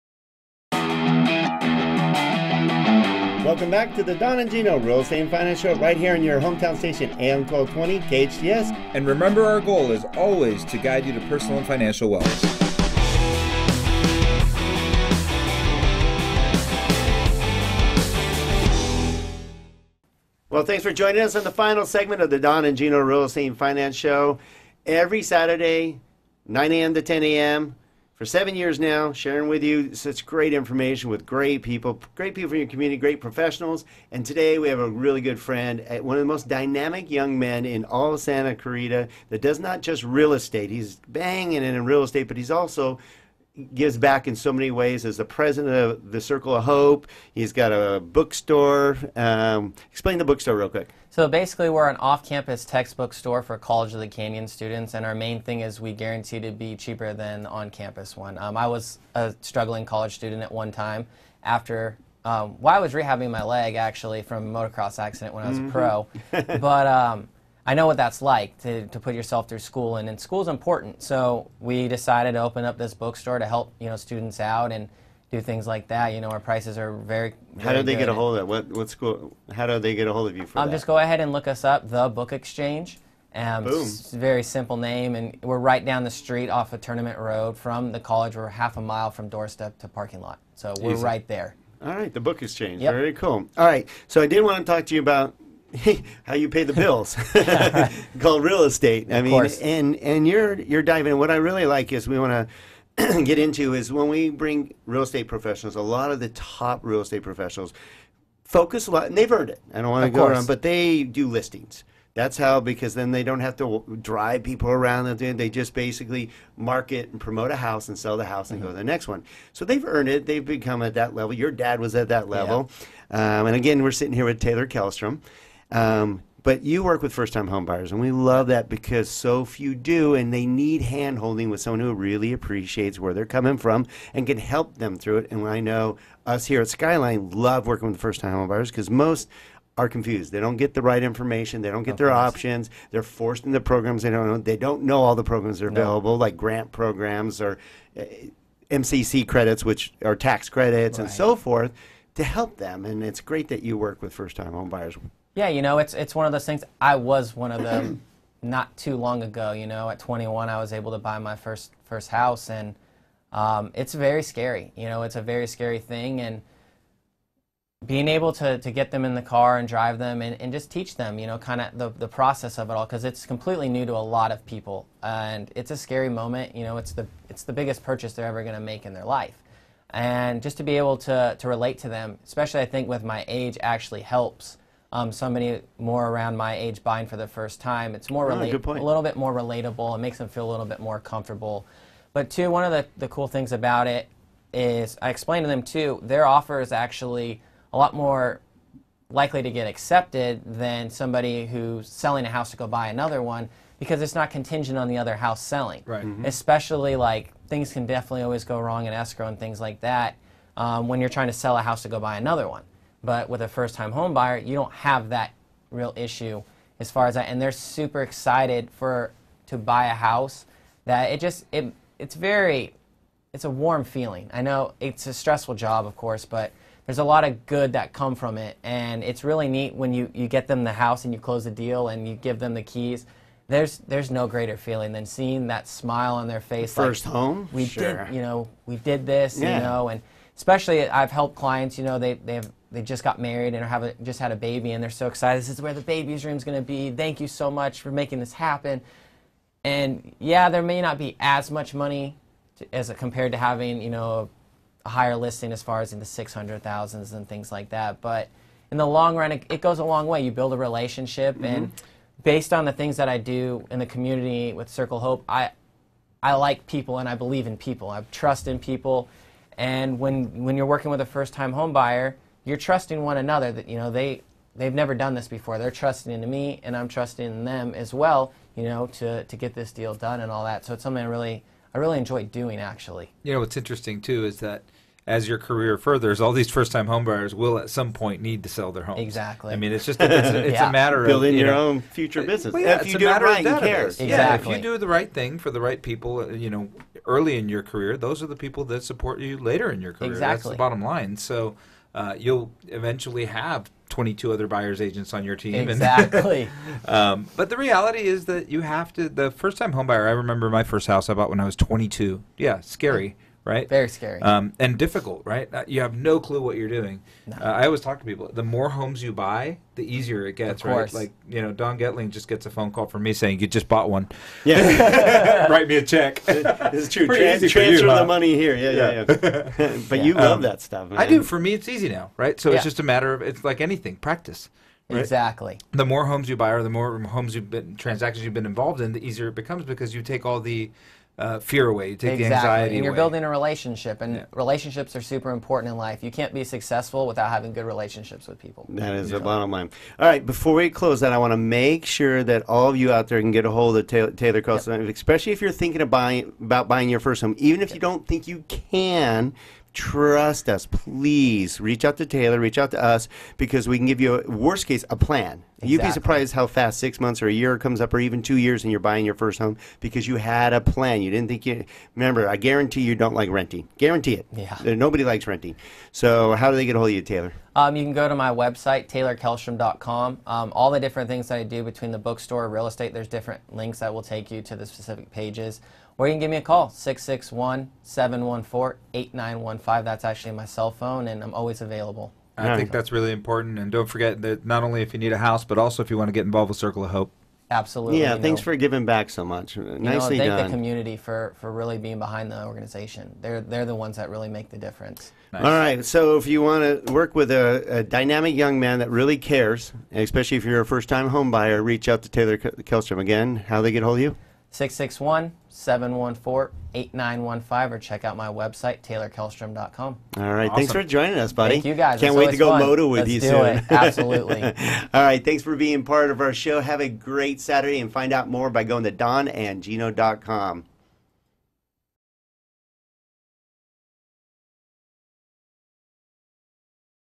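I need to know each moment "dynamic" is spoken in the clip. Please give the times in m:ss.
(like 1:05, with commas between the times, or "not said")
0:36, 6:47.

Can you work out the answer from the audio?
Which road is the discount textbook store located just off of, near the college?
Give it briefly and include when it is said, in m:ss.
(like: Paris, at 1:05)
Tournament Road, at 1:26.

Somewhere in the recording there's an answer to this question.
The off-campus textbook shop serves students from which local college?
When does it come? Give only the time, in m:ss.
0:53.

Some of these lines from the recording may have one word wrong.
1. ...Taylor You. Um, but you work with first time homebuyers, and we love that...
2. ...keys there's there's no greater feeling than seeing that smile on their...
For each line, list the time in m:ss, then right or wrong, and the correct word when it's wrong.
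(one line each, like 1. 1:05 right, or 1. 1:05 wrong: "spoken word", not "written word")
1. 2:04 wrong: "Kellstrom", not "You"
2. 3:52 right.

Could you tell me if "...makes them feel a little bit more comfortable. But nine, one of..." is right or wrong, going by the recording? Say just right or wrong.
wrong.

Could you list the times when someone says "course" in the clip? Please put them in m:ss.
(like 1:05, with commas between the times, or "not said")
1:39, 2:22, 3:45.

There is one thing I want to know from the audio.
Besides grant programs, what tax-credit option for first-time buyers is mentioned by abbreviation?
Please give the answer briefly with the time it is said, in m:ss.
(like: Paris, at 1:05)
MCC credits, at 2:28.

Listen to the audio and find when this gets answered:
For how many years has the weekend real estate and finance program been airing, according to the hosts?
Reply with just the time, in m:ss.
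0:28.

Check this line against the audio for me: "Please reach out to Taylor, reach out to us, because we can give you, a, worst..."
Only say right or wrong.
right.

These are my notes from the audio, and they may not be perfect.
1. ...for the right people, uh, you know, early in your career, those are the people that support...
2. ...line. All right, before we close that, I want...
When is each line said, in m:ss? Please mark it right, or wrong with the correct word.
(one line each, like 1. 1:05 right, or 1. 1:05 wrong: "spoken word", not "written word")
1. 4:55 right
2. 5:49 right.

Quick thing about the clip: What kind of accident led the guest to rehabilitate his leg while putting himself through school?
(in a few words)
motocross accident.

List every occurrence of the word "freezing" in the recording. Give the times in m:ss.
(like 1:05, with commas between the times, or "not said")
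not said.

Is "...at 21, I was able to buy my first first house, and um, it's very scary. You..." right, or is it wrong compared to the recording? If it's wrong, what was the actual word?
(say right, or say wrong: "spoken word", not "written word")
right.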